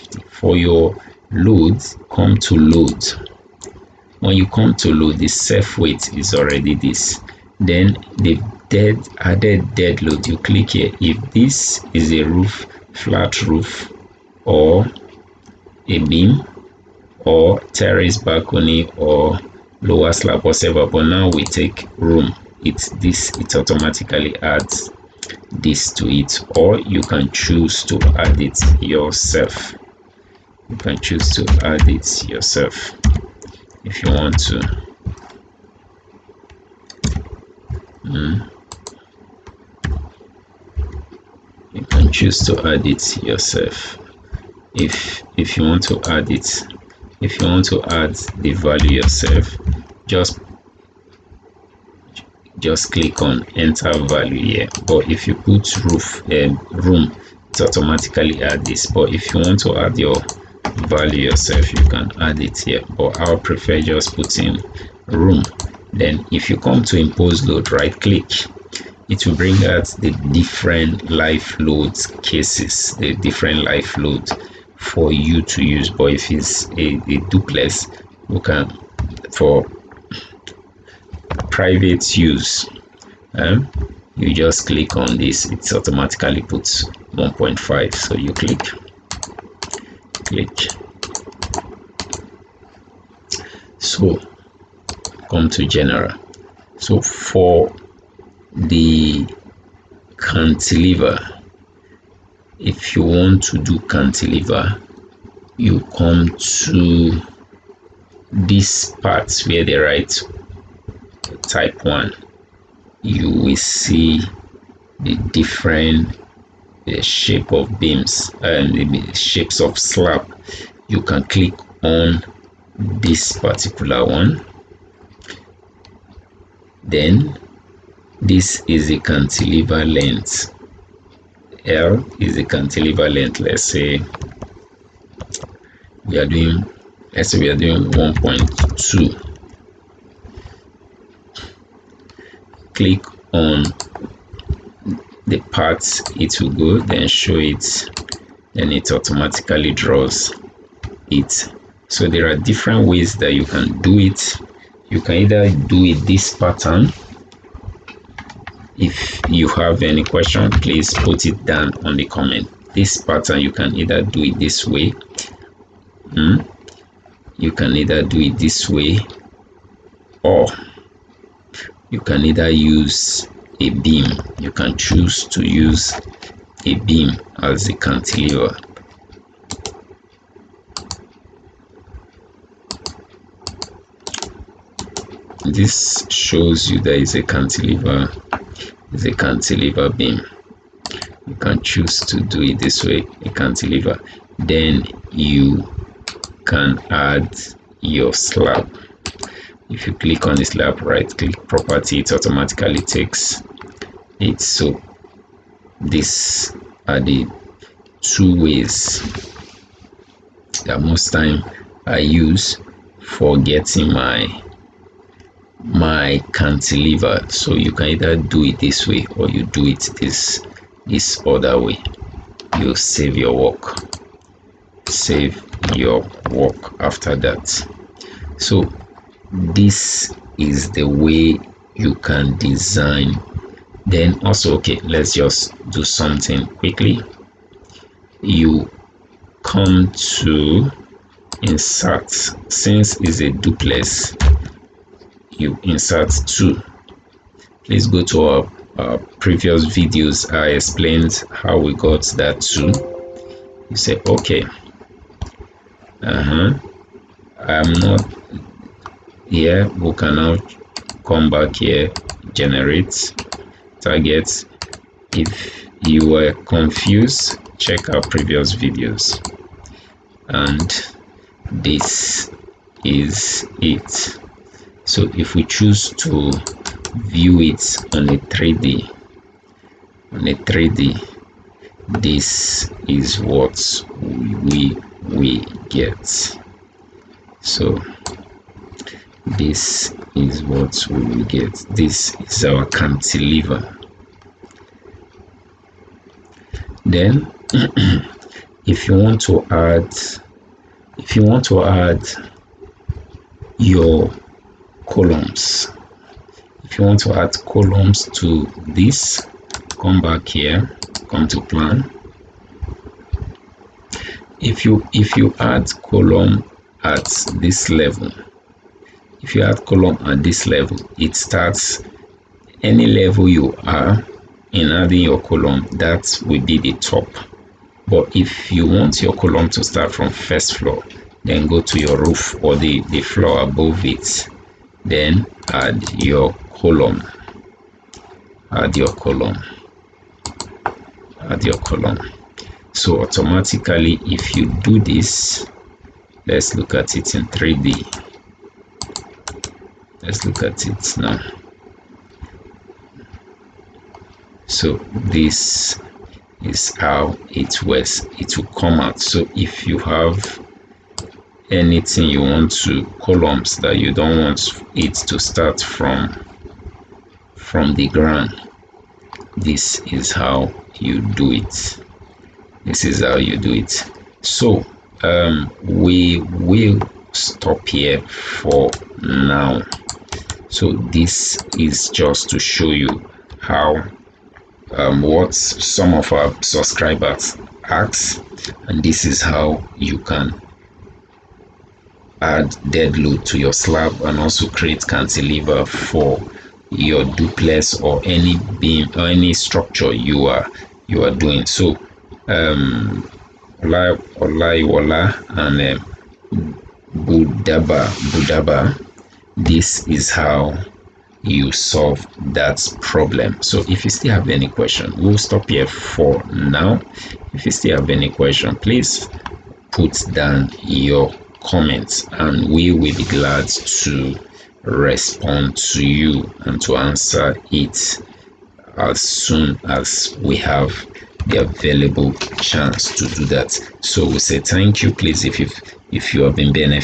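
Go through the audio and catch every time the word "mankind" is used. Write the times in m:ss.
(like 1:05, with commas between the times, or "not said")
not said.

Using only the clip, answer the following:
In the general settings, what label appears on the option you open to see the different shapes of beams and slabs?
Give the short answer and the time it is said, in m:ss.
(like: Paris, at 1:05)
type 1, at 1:51.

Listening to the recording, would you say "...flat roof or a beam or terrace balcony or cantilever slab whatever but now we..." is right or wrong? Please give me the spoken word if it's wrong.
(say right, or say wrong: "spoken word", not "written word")
wrong: "lower", not "cantilever".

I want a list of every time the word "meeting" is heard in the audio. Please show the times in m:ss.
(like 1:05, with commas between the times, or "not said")
not said.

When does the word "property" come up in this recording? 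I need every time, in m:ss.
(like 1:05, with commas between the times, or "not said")
3:21.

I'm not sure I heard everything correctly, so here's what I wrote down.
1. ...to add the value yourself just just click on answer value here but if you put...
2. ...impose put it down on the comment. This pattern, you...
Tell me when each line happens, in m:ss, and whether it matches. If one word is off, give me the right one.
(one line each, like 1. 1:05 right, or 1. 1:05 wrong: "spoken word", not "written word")
1. 0:47 wrong: "enter", not "answer"
2. 2:40 wrong: "please", not "impose".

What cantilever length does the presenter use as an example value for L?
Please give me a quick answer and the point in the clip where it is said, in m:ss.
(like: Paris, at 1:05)
1.2, at 2:17.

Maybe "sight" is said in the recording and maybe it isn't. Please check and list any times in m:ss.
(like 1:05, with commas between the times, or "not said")
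not said.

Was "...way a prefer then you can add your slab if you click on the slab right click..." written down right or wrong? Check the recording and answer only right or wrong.
wrong.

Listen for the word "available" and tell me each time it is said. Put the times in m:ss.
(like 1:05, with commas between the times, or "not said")
7:11.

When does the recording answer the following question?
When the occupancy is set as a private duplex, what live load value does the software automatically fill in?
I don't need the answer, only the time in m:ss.
1:26.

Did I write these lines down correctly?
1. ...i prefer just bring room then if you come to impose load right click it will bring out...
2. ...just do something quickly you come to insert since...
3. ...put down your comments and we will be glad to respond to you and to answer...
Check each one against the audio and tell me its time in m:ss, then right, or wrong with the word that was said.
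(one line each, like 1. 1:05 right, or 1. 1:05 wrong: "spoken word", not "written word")
1. 1:03 wrong: "putting", not "bring"
2. 3:55 right
3. 6:59 right.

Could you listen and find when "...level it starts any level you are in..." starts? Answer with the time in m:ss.
5:20.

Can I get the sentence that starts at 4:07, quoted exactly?
Please go to our, our previous videos.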